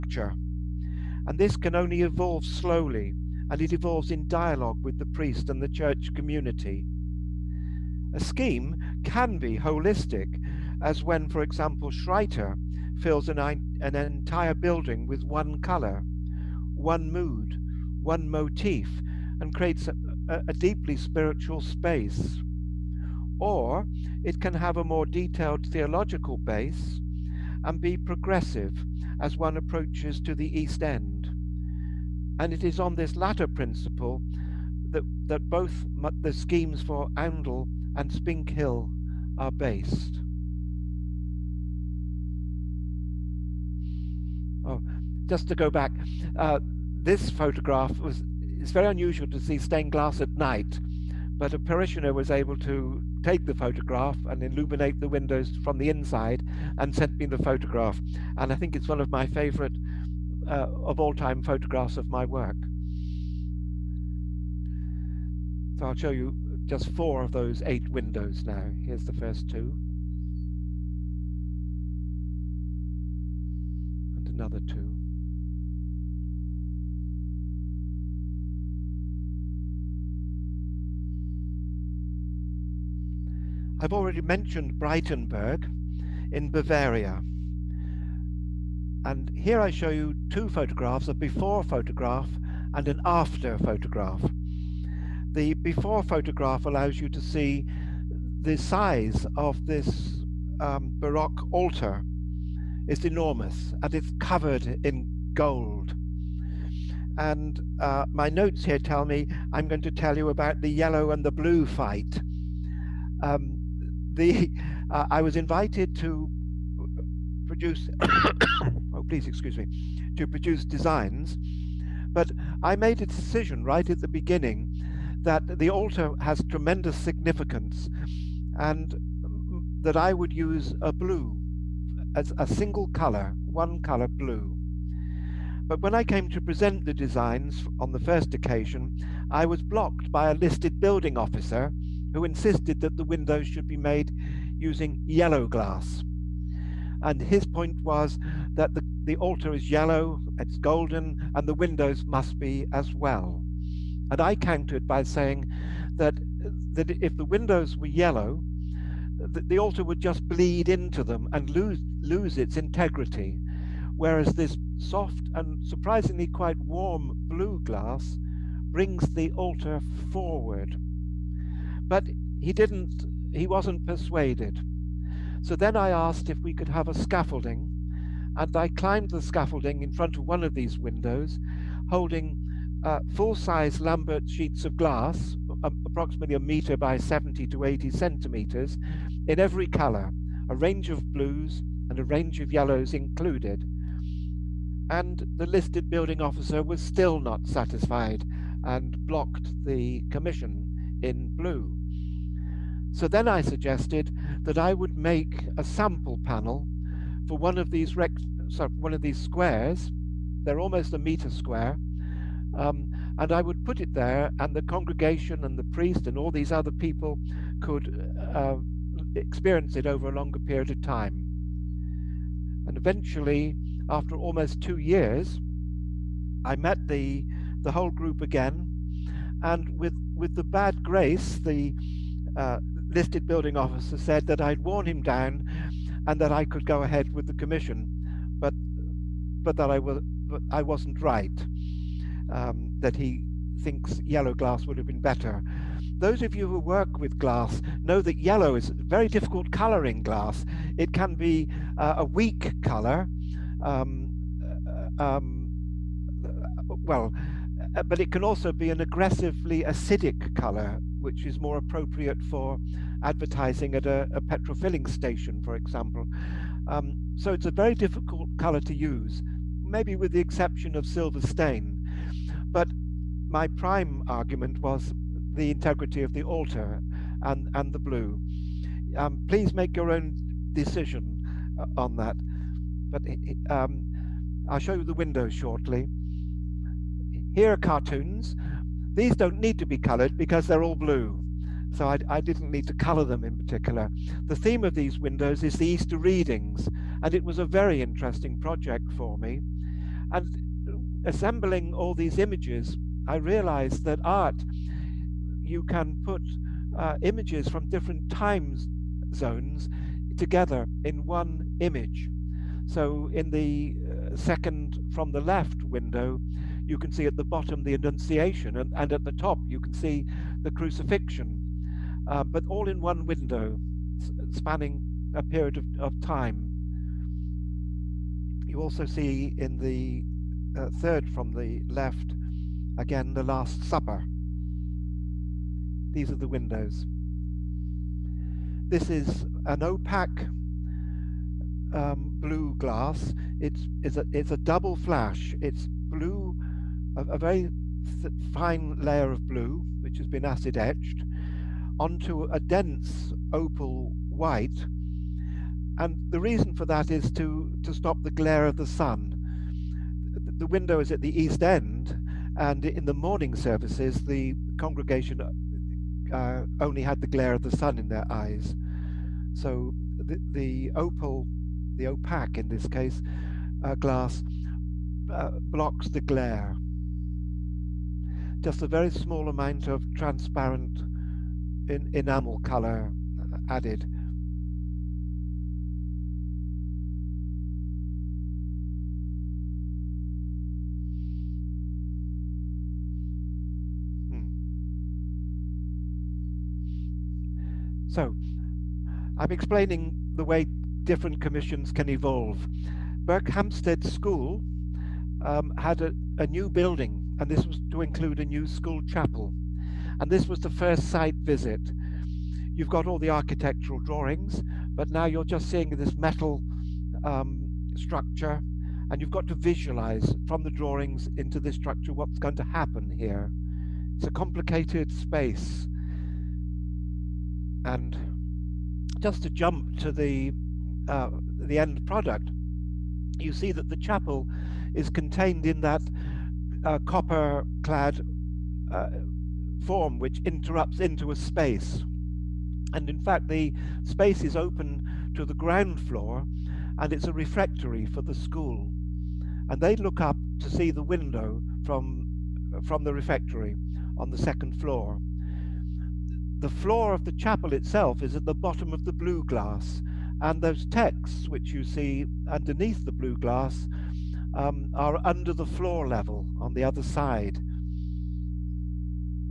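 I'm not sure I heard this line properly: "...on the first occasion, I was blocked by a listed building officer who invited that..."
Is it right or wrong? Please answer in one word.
wrong.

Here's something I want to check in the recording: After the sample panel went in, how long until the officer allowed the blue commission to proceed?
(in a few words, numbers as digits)
Almost 2 years.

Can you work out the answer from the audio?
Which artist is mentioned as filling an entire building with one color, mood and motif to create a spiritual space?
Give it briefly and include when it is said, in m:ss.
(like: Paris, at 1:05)
Schreiter, at 0:11.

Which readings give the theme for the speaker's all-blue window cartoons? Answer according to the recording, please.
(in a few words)
Easter readings.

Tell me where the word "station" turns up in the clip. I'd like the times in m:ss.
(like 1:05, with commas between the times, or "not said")
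4:24.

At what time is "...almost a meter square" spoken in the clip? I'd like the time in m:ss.
3:30.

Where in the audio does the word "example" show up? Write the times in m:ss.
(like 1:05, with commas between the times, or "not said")
0:11, 4:25.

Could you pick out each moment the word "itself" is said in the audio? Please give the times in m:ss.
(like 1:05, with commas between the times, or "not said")
7:37.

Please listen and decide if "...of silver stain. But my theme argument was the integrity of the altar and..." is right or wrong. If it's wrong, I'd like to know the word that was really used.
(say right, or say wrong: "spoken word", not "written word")
wrong: "prime", not "theme".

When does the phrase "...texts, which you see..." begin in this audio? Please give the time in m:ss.
7:40.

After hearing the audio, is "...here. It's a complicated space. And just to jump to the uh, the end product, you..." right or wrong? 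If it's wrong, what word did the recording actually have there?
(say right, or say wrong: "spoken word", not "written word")
right.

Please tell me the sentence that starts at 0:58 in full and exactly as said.
And I think it's one of my favorite uh, of all time photographs of my work.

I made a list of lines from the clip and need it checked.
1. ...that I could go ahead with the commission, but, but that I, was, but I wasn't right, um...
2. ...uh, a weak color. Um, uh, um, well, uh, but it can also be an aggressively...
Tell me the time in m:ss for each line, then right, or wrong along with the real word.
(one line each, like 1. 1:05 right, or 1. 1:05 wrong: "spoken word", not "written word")
1. 3:56 right
2. 4:11 right.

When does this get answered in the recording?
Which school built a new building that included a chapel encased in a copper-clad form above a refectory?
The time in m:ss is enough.
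6:43.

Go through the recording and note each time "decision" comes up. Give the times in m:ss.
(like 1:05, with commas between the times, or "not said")
2:03, 4:40.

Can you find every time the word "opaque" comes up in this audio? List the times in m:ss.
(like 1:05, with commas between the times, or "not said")
5:39, 6:11.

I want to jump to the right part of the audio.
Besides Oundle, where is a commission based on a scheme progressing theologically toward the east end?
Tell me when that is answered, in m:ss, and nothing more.
0:38.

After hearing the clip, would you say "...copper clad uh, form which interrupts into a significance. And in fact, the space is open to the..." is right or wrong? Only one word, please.
wrong.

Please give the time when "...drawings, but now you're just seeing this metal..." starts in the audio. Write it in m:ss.
6:53.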